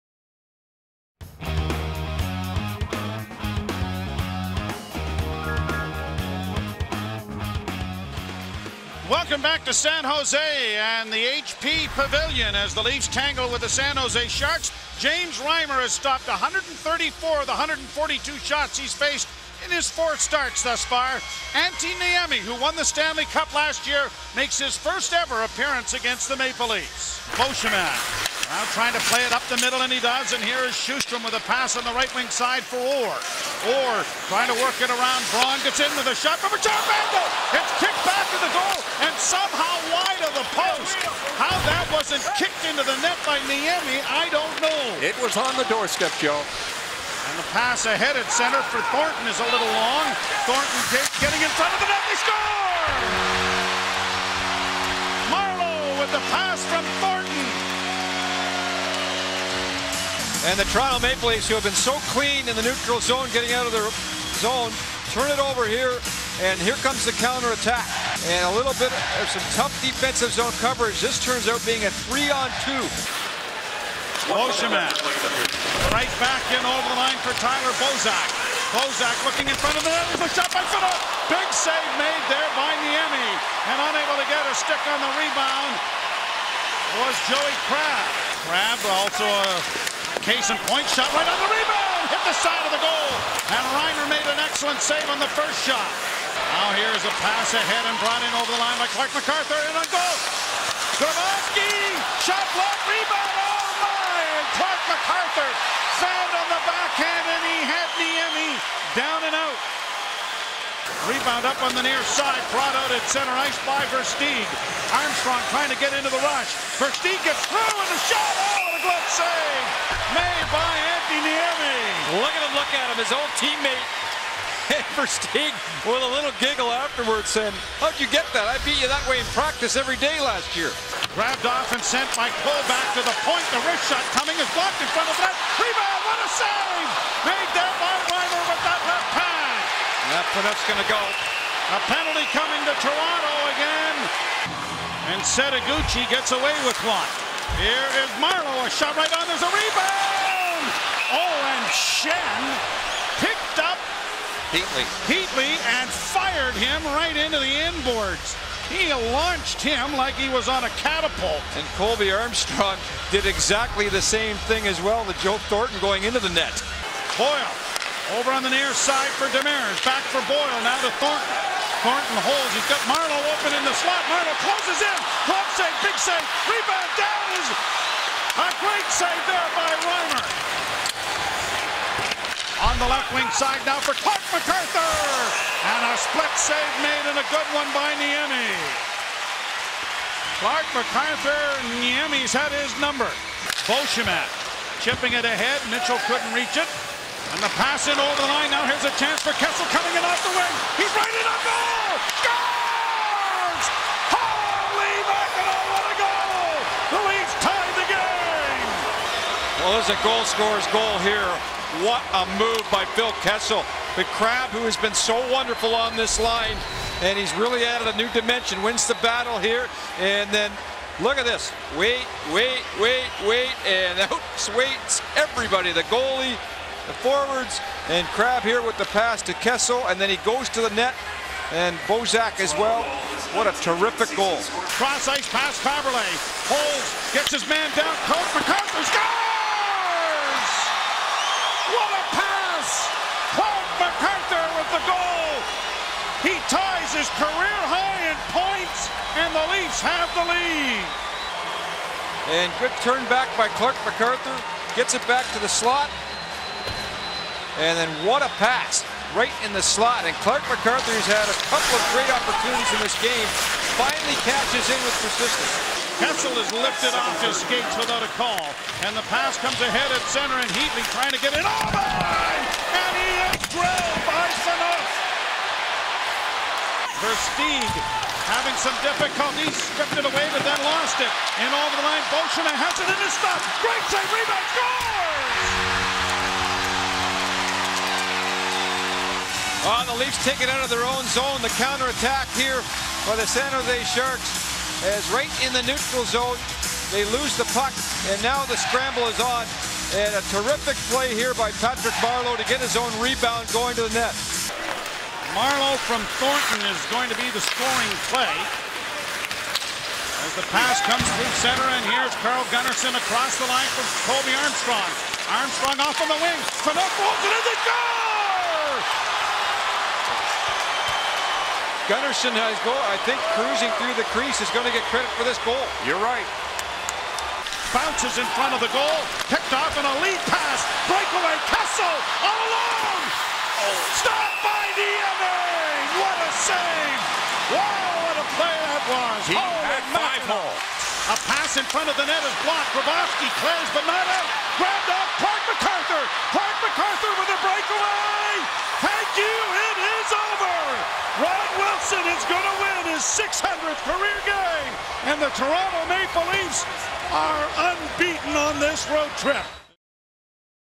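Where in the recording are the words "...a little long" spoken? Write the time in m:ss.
0:49.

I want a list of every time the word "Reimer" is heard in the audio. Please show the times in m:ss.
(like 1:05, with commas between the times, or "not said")
0:15, 1:33, 2:18, 2:59.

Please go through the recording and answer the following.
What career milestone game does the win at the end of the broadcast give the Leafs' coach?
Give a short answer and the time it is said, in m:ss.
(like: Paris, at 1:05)
600th, at 5:53.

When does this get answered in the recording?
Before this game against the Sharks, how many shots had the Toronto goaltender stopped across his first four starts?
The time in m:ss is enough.
0:16.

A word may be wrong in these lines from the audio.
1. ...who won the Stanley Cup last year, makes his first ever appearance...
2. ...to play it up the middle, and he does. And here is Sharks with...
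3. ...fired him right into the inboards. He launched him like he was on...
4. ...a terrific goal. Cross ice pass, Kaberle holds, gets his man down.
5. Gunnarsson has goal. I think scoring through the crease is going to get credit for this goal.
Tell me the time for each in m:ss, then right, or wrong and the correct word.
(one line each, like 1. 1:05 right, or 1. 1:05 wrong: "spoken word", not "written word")
1. 0:22 right
2. 0:28 wrong: "Sjostrom", not "Sharks"
3. 2:35 right
4. 3:53 right
5. 5:21 wrong: "cruising", not "scoring".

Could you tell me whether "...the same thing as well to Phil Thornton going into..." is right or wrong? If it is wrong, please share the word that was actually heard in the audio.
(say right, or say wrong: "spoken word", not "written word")
wrong: "Joe", not "Phil".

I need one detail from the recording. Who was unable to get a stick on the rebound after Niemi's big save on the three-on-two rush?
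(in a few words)
Joey Crabb.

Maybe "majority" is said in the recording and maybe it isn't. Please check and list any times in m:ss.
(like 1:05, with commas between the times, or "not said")
not said.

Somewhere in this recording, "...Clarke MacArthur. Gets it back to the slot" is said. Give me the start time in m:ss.
4:13.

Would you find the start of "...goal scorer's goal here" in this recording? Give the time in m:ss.
3:30.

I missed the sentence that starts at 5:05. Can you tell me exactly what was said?
Marleau from Thornton is going to be the scoring play.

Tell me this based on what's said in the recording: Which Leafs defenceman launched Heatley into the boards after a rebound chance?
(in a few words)
Schenn.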